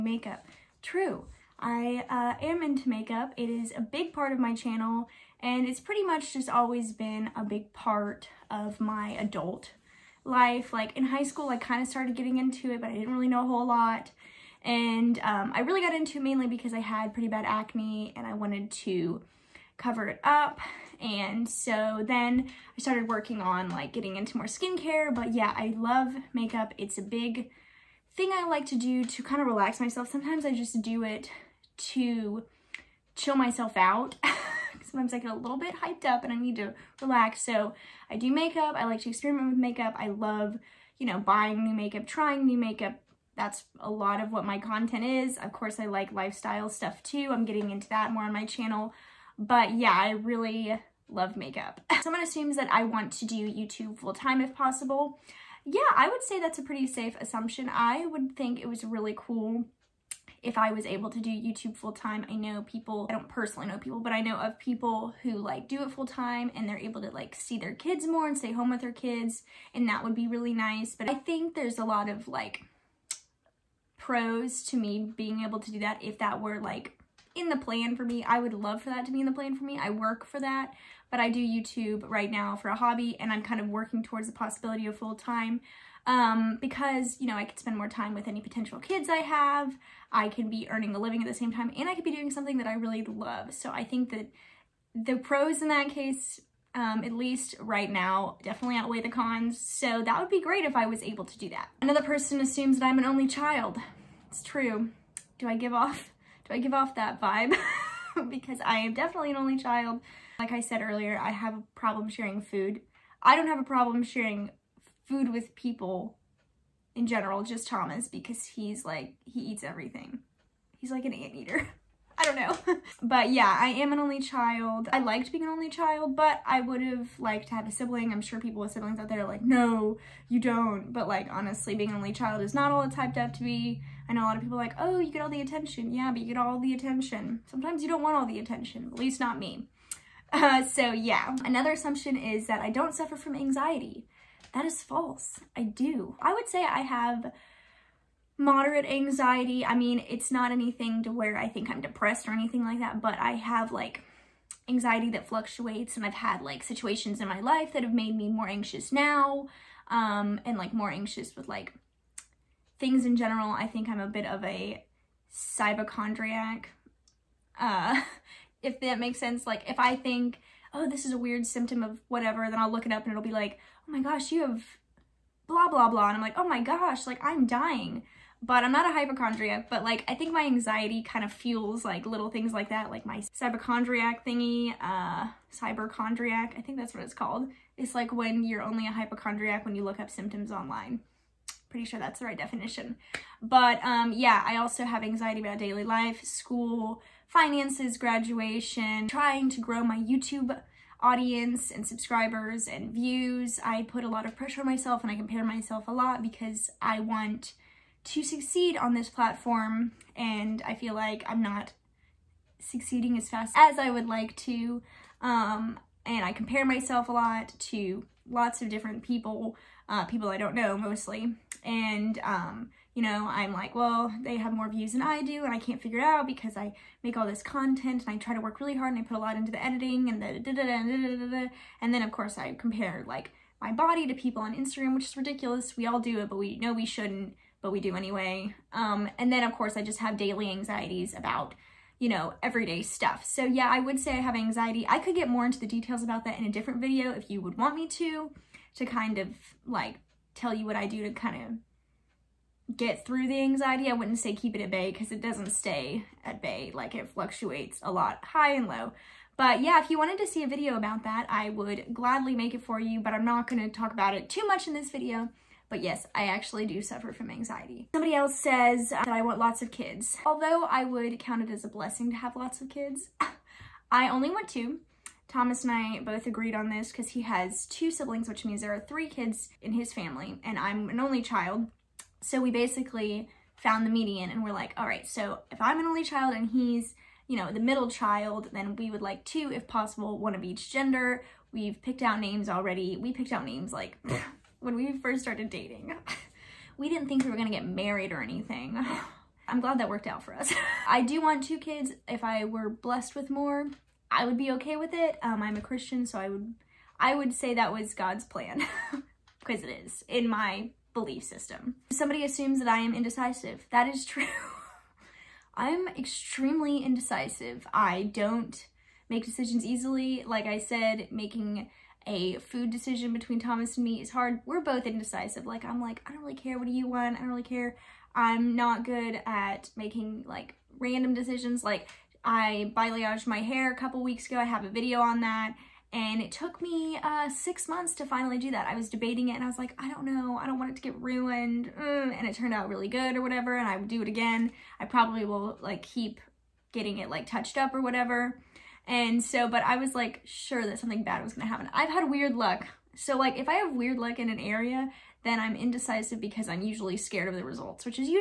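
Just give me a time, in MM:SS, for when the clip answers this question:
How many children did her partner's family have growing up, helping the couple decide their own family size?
04:38.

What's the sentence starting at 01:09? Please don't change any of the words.
And that would be really nice.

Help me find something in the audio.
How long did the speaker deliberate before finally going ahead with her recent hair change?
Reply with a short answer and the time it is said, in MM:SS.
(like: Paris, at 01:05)
6 months, at 05:37.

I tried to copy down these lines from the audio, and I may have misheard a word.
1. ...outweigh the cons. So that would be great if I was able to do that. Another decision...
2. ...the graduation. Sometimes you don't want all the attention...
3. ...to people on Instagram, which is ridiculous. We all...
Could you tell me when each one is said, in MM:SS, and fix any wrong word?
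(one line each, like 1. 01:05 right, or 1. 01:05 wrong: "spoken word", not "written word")
1. 01:38 wrong: "person", not "decision"
2. 02:16 wrong: "attention", not "graduation"
3. 03:54 right.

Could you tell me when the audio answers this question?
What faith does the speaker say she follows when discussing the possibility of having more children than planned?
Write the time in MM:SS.
05:05.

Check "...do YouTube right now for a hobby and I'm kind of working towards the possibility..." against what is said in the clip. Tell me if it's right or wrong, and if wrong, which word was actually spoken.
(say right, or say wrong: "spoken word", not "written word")
right.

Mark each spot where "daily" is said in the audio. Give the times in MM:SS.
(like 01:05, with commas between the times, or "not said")
03:15, 04:00.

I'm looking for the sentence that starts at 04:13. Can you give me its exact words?
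I wouldn't say keep it at bay because it doesn't stay at bay.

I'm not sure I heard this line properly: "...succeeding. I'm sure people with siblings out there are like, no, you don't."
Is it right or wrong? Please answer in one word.
wrong.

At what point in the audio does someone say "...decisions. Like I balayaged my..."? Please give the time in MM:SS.
05:31.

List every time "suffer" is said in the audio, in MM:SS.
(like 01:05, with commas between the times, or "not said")
02:22, 04:26.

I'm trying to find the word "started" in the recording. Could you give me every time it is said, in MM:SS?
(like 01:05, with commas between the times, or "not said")
00:11, 00:22, 04:55.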